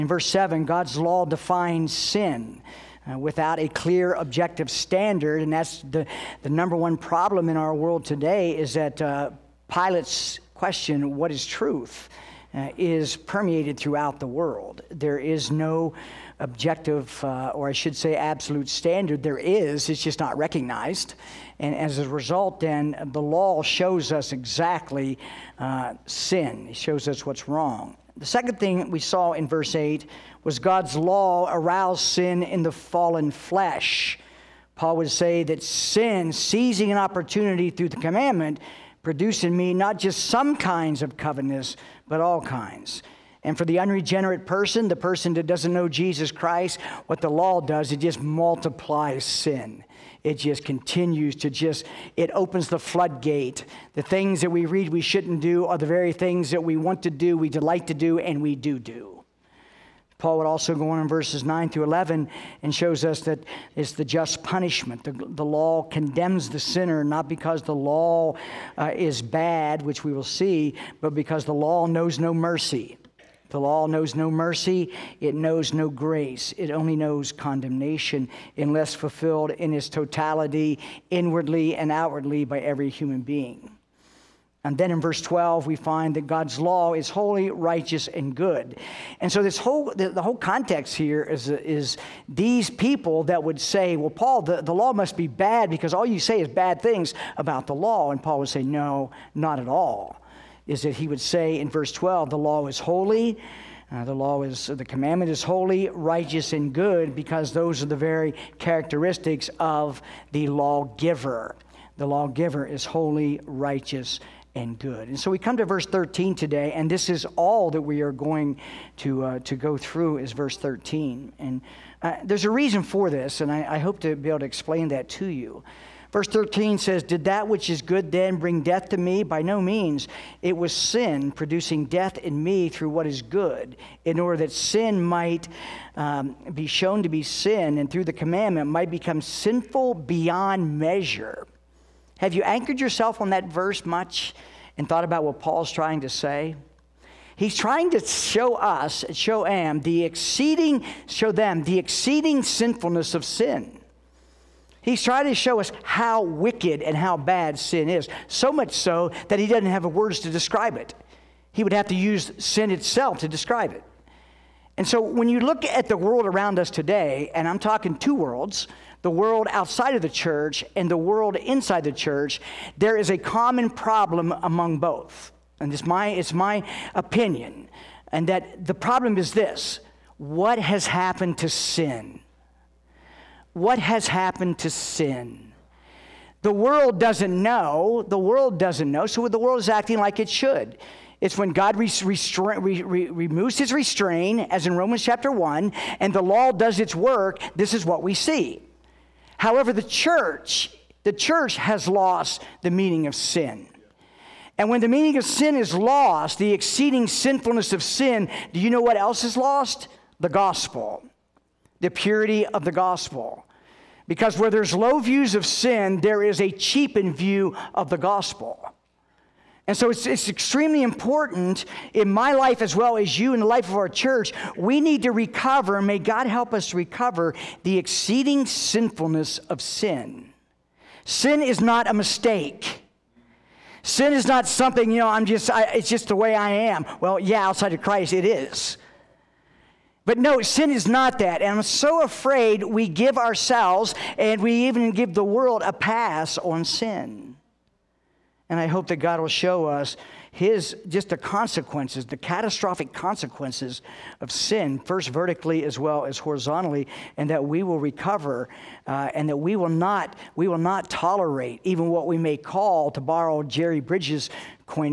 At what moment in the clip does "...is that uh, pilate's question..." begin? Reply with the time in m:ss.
0:08.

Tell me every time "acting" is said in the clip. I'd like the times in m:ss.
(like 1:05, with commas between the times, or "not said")
3:09.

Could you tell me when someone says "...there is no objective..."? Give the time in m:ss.
0:14.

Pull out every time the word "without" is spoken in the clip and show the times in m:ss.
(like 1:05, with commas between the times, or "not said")
0:03.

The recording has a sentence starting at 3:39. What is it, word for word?
And so it's, it's extremely important in my life as well as you in the life of our church.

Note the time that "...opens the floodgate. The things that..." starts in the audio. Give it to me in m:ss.
0:52.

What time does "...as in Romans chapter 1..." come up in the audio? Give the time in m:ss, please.
3:14.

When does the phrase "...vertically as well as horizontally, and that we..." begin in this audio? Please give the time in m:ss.
4:15.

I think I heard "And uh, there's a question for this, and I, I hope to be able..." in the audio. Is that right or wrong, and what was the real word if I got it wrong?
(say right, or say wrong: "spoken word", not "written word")
wrong: "reason", not "question".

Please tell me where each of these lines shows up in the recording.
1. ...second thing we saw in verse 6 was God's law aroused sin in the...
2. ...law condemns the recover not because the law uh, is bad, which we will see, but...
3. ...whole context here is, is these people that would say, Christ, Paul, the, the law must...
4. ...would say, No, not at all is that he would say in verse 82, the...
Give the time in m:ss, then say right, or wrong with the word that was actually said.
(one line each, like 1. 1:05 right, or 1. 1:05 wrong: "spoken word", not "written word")
1. 0:28 wrong: "8", not "6"
2. 1:05 wrong: "sinner", not "recover"
3. 1:30 wrong: "Well", not "Christ"
4. 1:38 wrong: "12", not "82".